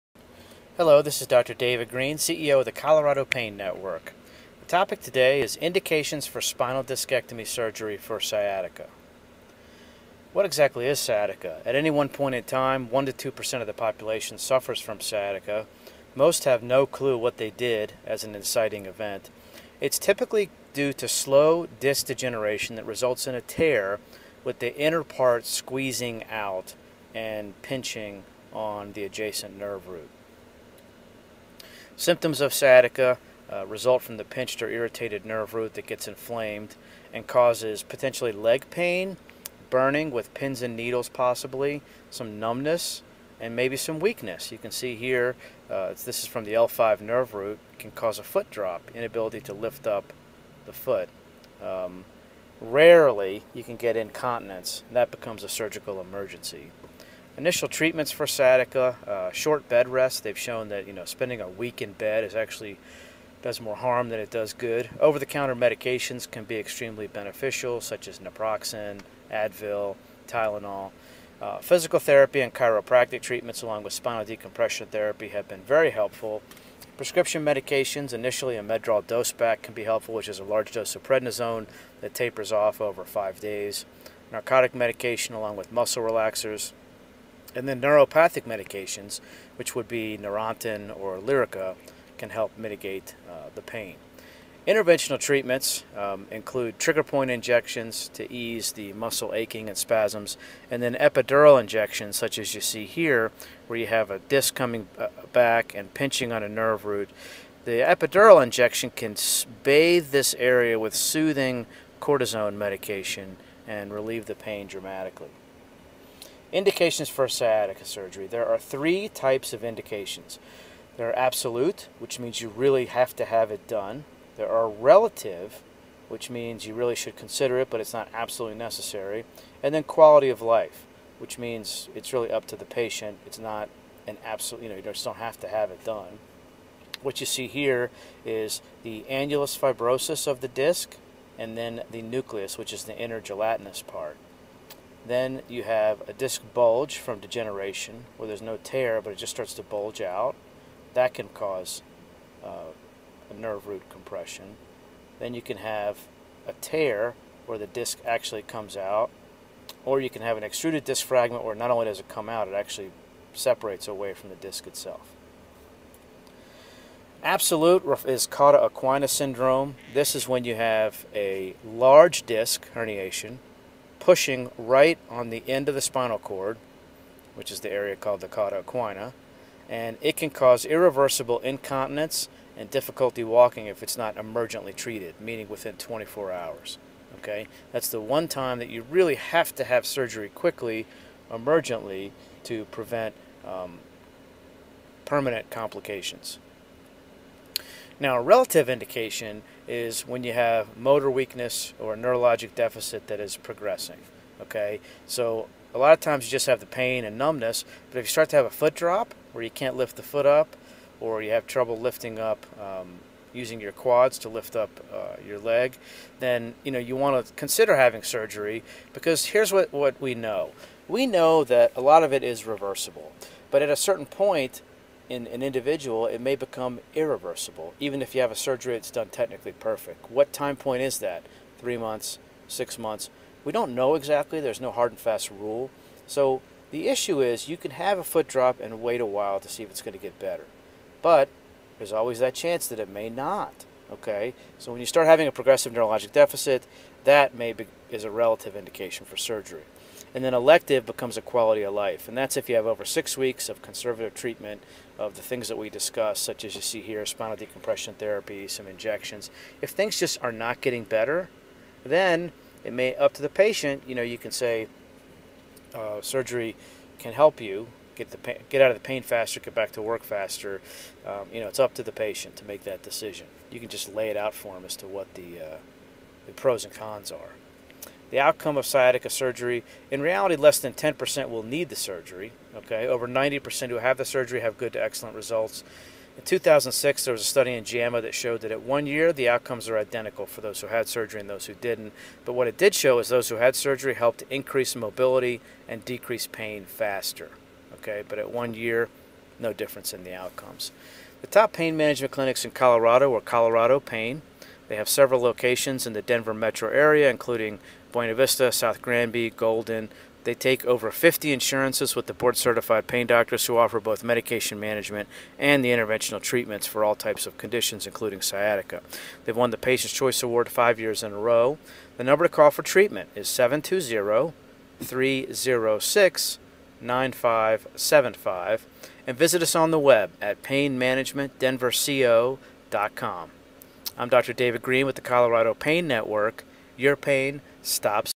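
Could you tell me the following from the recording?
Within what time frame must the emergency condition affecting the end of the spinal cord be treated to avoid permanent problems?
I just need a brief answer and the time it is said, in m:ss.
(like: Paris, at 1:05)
24 hours, at 3:05.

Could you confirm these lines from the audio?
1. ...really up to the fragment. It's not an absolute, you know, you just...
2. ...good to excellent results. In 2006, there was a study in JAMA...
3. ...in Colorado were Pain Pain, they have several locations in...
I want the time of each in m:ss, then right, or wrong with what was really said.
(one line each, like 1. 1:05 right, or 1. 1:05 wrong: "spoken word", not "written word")
1. 2:12 wrong: "patient", not "fragment"
2. 4:44 right
3. 5:02 wrong: "Colorado", not "Pain".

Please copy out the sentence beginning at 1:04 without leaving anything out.
Over-the-counter medications can be extremely beneficial, such as naproxen, Advil, Tylenol.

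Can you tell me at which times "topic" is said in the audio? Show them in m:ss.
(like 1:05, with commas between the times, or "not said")
0:04.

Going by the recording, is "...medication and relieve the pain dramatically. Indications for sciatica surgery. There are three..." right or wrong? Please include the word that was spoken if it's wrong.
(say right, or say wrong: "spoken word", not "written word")
right.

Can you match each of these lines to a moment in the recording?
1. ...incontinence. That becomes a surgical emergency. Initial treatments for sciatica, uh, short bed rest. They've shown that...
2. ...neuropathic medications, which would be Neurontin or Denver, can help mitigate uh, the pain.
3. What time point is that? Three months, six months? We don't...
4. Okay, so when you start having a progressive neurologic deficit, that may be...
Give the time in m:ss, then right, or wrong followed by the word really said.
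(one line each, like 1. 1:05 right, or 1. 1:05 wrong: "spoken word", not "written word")
1. 0:53 right
2. 1:27 wrong: "Lyrica", not "Denver"
3. 3:50 right
4. 4:03 right.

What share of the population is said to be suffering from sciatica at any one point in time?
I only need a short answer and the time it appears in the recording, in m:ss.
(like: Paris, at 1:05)
1 to 2%, at 0:12.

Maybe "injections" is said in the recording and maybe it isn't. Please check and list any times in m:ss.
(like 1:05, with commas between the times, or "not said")
1:37, 1:41, 1:48, 4:18.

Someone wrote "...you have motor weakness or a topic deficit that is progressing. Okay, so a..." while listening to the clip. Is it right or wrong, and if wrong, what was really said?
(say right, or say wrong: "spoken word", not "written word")
wrong: "neurologic", not "topic".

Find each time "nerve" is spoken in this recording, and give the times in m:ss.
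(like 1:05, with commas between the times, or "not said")
0:29, 0:35, 0:47, 1:46, 2:33.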